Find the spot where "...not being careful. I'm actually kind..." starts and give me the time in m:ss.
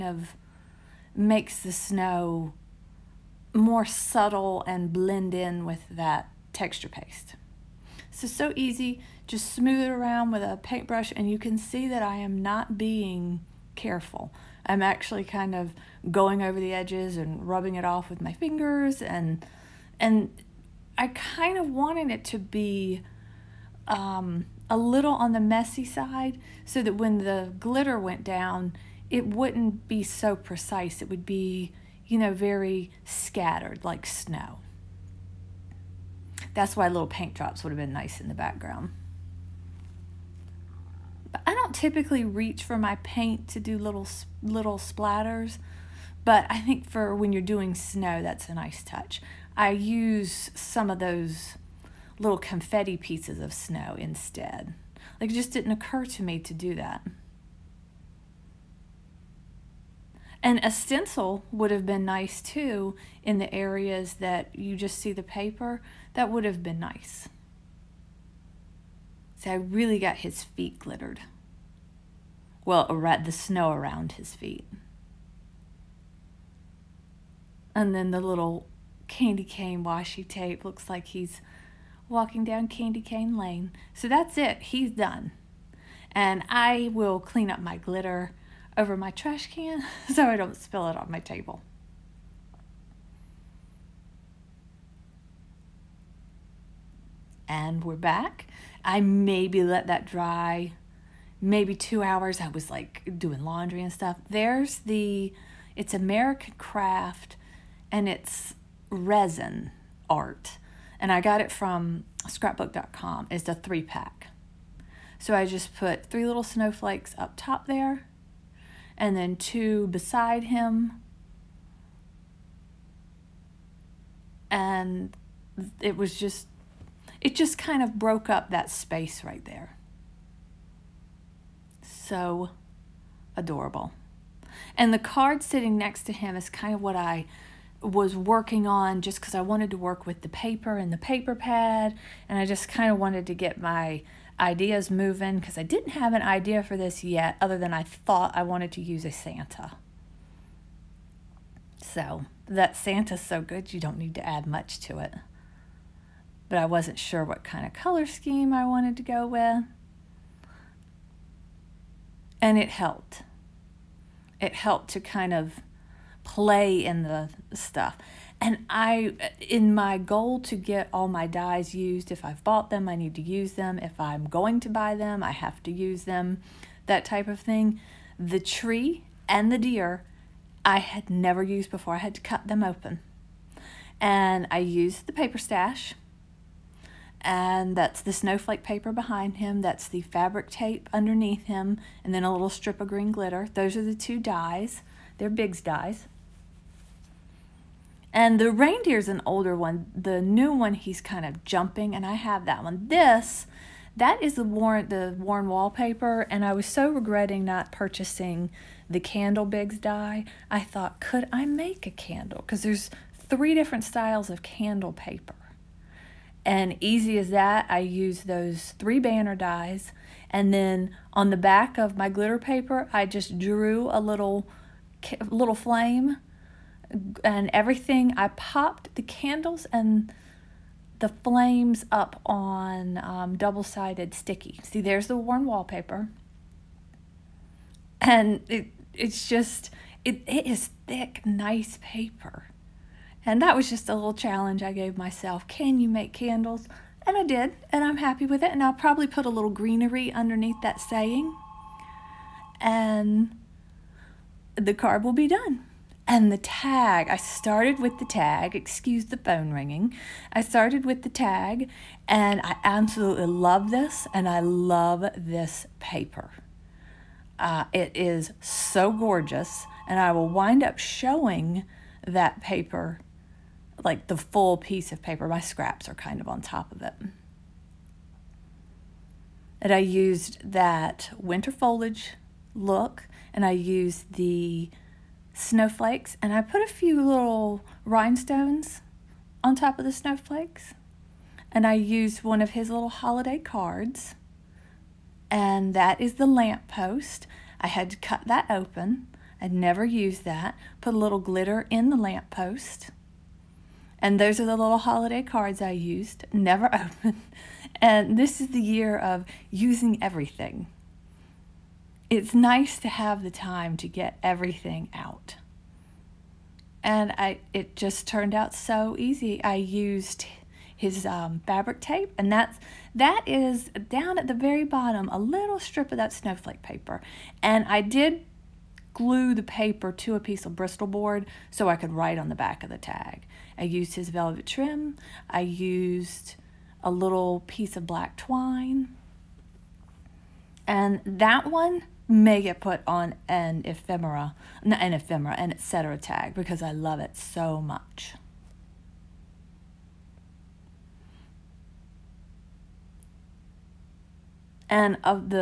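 0:12.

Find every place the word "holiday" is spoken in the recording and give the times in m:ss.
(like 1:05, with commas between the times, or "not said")
4:52, 5:04.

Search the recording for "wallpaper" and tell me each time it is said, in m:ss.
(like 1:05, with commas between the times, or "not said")
3:25, 3:55.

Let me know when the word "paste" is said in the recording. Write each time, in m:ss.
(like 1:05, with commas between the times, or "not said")
0:06.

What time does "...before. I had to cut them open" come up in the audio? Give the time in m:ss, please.
3:01.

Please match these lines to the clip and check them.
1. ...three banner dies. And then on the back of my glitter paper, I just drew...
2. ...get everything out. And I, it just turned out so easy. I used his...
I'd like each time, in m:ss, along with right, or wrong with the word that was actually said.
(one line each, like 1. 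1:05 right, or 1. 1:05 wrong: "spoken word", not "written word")
1. 3:38 right
2. 5:13 right.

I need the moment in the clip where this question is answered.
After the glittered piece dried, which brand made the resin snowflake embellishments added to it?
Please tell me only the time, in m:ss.
1:45.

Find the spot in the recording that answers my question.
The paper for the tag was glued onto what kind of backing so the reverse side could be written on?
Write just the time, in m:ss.
5:30.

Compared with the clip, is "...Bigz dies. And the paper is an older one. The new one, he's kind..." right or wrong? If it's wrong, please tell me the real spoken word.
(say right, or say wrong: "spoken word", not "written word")
wrong: "reindeer", not "paper".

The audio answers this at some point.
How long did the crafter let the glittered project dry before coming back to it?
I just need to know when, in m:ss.
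1:41.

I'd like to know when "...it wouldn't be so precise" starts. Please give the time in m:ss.
0:29.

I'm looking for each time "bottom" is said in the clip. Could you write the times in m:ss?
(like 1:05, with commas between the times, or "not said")
5:24.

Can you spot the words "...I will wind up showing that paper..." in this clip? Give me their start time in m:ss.
4:29.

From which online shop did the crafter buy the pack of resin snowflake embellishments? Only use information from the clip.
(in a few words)
scrapbook.com.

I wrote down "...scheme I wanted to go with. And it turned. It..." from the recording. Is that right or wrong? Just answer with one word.
wrong.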